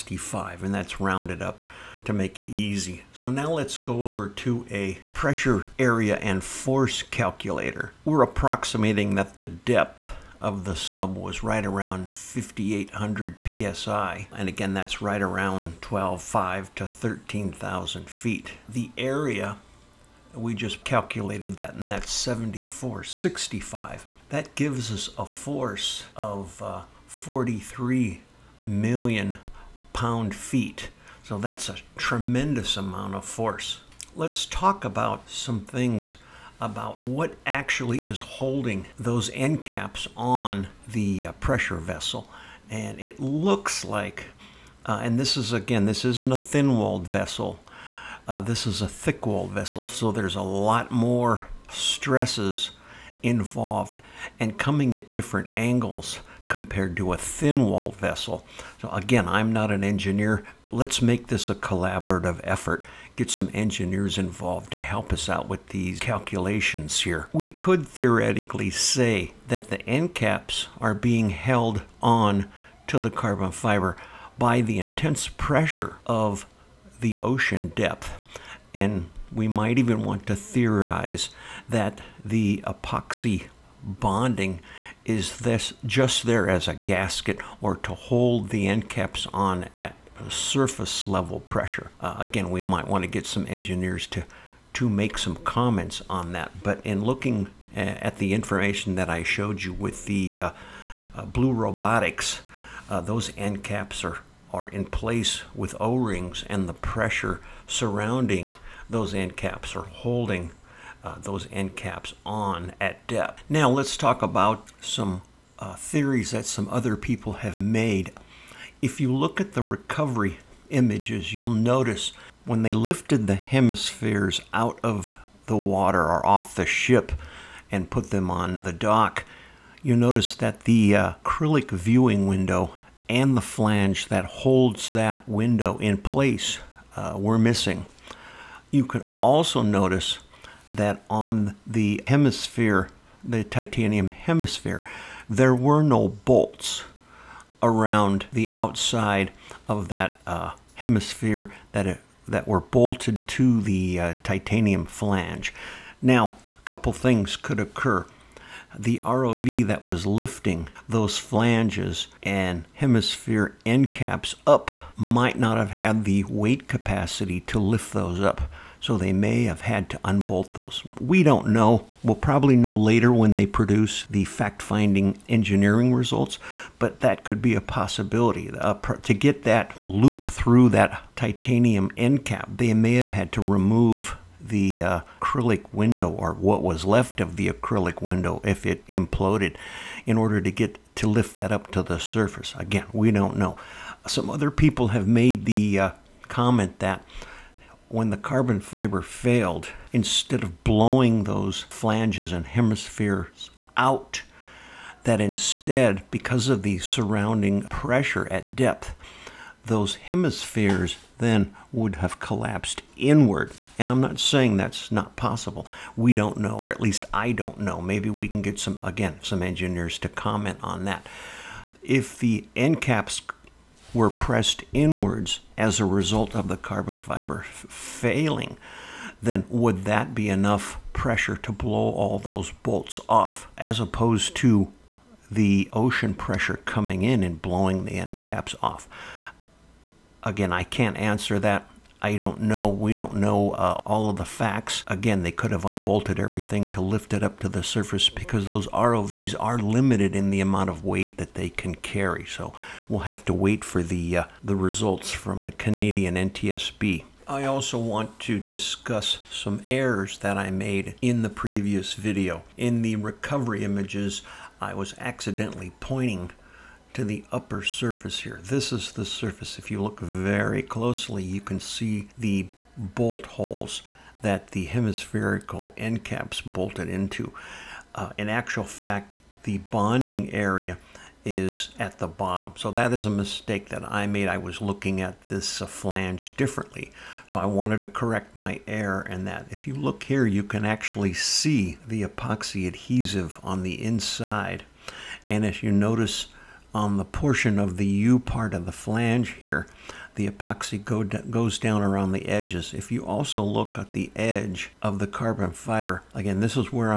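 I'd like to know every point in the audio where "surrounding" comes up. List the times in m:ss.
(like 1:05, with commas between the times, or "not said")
1:47, 3:26.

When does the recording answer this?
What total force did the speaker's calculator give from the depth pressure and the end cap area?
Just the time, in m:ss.
0:27.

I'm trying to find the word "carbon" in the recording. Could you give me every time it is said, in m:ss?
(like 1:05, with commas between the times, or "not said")
1:13, 3:18, 3:46, 5:05.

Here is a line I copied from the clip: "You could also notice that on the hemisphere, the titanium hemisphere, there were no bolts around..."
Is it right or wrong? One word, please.
right.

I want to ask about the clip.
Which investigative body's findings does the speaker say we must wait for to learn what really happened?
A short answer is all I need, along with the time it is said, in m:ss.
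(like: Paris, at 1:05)
Canadian NTSB, at 4:15.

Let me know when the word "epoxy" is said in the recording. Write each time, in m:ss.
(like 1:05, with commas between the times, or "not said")
1:22, 4:52, 5:00.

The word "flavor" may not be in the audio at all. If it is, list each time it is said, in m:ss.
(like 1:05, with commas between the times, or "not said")
not said.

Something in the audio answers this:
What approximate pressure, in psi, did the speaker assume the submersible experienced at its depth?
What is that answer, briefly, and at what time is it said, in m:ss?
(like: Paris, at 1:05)
5,800 psi, at 0:12.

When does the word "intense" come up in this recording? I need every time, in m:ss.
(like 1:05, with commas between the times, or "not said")
1:14.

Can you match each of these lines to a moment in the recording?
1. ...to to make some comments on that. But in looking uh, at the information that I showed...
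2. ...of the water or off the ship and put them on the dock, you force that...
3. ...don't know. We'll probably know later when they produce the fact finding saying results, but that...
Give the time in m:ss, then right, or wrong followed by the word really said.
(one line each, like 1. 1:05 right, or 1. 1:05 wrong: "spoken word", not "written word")
1. 1:34 right
2. 2:04 wrong: "notice", not "force"
3. 2:51 wrong: "engineering", not "saying".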